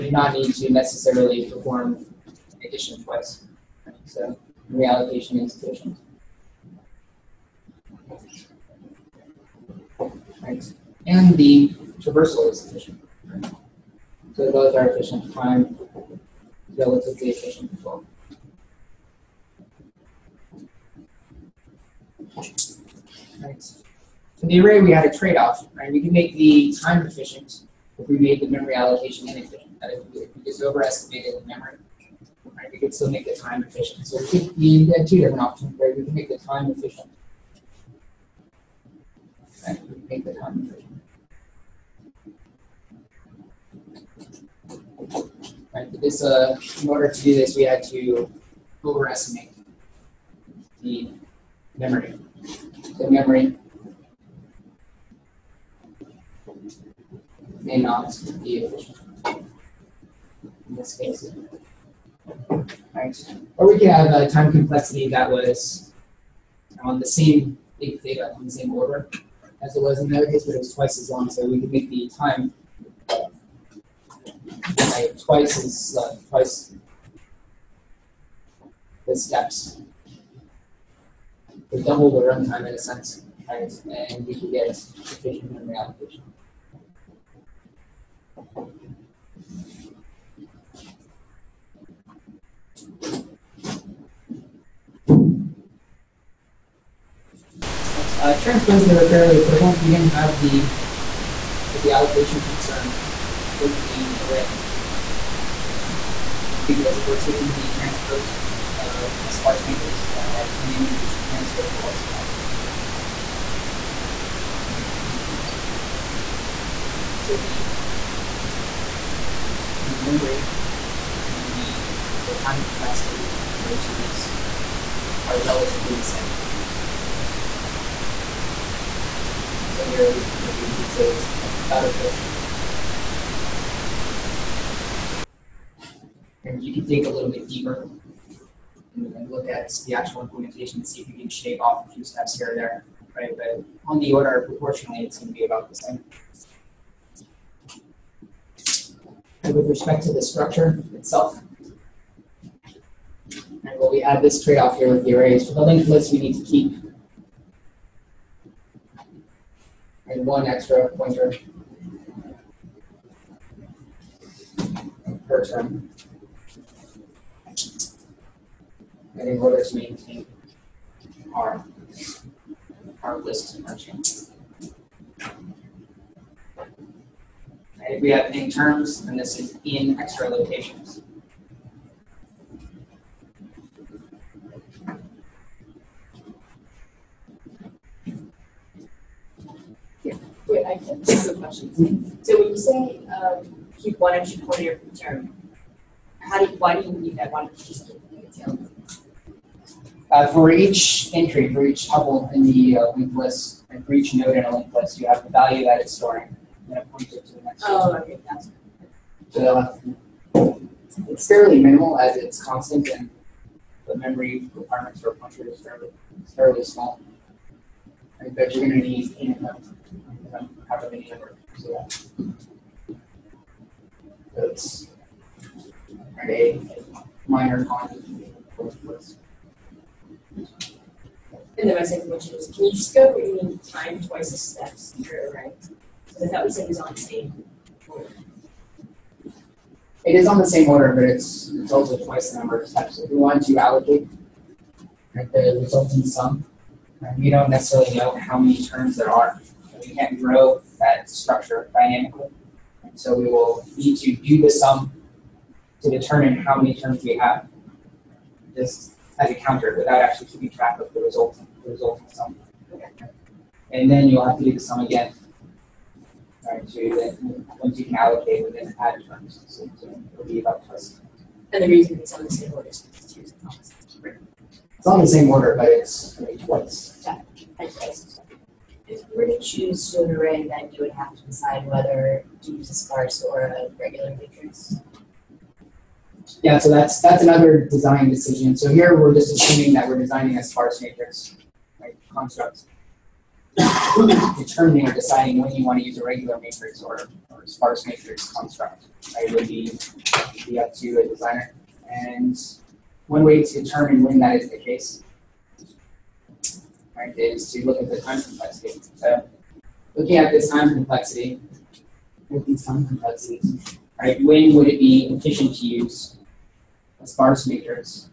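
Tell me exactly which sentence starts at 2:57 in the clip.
If we have in terms, then this is in extra locations.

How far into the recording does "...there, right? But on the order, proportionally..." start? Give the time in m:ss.
2:22.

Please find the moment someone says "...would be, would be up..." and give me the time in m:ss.
4:59.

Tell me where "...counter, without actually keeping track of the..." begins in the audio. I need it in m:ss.
4:19.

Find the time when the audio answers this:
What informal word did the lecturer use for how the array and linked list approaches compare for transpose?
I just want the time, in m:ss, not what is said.
2:11.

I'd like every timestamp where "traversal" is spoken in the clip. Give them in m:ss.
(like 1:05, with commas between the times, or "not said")
0:12.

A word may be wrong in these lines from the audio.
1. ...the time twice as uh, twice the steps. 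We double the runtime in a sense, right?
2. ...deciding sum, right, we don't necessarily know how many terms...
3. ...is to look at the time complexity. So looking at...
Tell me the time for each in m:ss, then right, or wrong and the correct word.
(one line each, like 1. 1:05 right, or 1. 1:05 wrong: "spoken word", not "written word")
1. 1:11 right
2. 4:05 wrong: "resulting", not "deciding"
3. 5:07 right.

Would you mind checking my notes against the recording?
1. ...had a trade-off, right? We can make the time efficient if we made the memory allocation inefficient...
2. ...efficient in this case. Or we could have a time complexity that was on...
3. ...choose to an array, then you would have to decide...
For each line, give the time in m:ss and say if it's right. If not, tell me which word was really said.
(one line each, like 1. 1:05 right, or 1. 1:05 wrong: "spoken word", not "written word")
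1. 0:24 right
2. 0:58 right
3. 4:39 right.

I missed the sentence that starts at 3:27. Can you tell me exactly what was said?
Oh, uh, okay, That's So it's fairly minimal as it's constant and the memory requirements for a pointer is fairly, fairly small.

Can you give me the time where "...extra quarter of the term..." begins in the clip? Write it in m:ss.
3:14.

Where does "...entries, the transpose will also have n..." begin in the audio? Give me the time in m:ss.
1:50.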